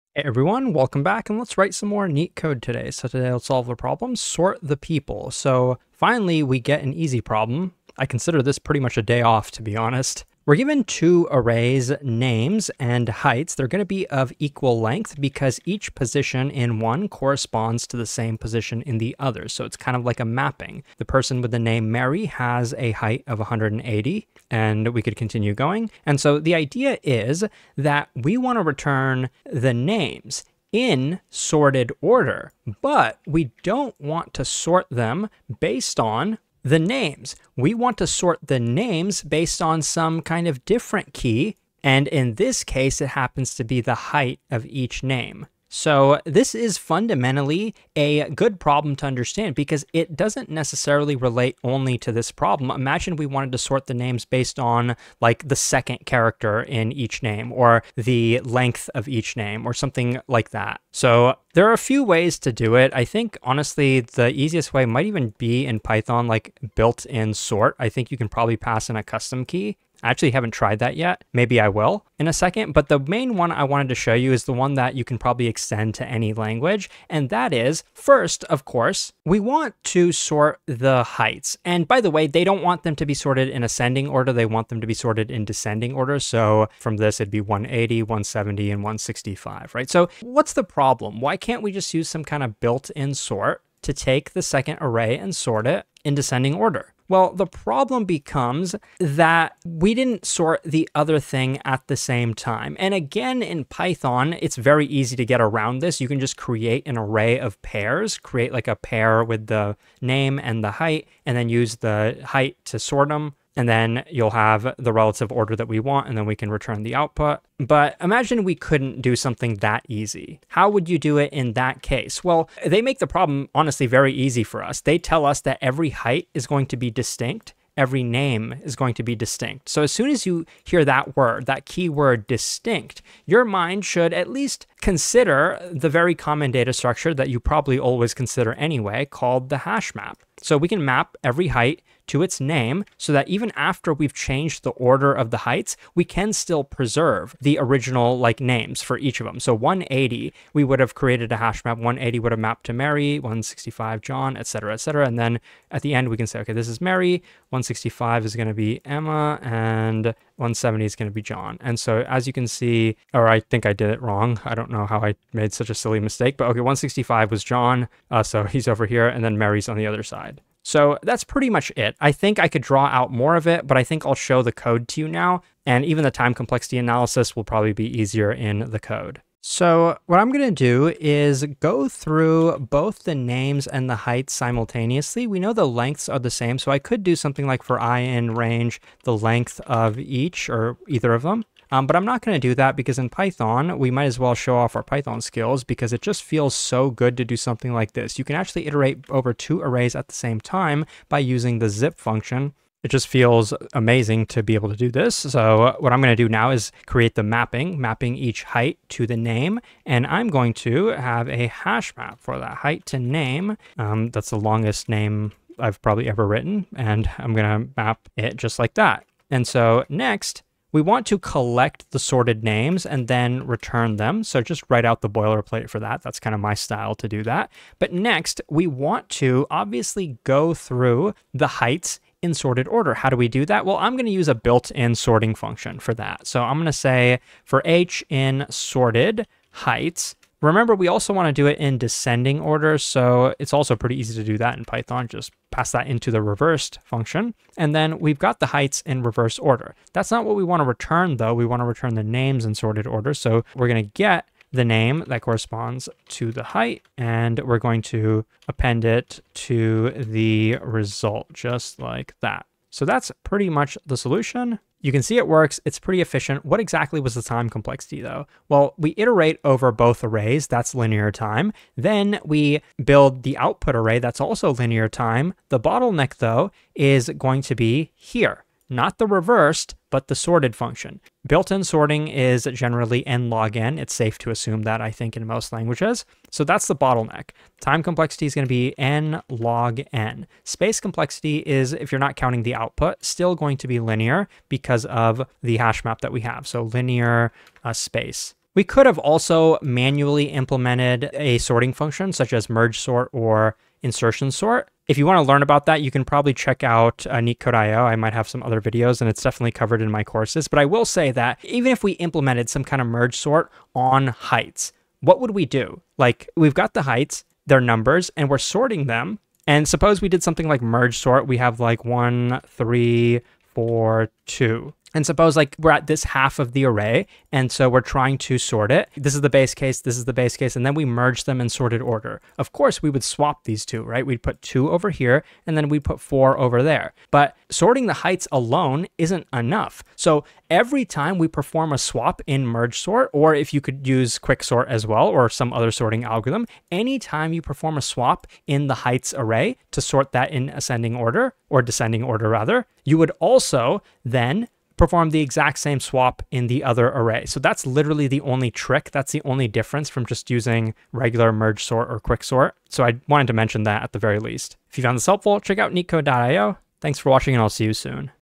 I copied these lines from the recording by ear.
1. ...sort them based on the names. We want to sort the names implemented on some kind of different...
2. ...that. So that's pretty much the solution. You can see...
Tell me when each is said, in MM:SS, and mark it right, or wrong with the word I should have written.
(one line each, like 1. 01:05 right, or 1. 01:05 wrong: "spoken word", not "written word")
1. 00:34 wrong: "based", not "implemented"
2. 04:22 right.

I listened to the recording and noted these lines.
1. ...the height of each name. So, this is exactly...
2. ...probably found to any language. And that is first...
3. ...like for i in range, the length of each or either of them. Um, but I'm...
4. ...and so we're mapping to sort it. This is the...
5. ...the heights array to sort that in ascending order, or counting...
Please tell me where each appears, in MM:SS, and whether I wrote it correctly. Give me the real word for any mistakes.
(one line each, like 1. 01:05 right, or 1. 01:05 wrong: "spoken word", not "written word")
1. 00:43 wrong: "fundamentally", not "exactly"
2. 01:15 wrong: "extend", not "found"
3. 03:07 right
4. 05:27 wrong: "trying", not "mapping"
5. 05:48 wrong: "descending", not "counting".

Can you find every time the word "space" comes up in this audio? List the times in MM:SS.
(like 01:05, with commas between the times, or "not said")
04:50, 04:57.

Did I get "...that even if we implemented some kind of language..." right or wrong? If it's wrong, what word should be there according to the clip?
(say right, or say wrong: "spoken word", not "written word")
wrong: "merge", not "language".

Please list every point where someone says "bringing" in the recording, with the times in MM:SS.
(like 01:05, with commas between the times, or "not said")
not said.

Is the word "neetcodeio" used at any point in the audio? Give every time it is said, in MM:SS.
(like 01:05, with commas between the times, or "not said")
05:07, 06:05.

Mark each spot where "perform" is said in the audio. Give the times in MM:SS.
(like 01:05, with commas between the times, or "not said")
05:41, 05:47, 05:54.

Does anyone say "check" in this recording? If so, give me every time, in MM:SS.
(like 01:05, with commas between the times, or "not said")
05:06, 06:05.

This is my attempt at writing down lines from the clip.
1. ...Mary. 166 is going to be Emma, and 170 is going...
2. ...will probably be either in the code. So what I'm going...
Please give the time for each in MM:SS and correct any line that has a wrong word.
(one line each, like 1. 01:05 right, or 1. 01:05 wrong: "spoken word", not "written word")
1. 02:36 wrong: "165", not "166"
2. 02:57 wrong: "easier", not "either".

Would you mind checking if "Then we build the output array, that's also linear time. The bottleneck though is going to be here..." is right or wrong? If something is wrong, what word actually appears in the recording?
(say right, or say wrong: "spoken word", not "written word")
right.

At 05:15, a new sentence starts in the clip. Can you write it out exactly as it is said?
Like we've got the heights, their numbers, and we're sorting them.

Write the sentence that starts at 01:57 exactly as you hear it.
But imagine we couldn't do something that easy.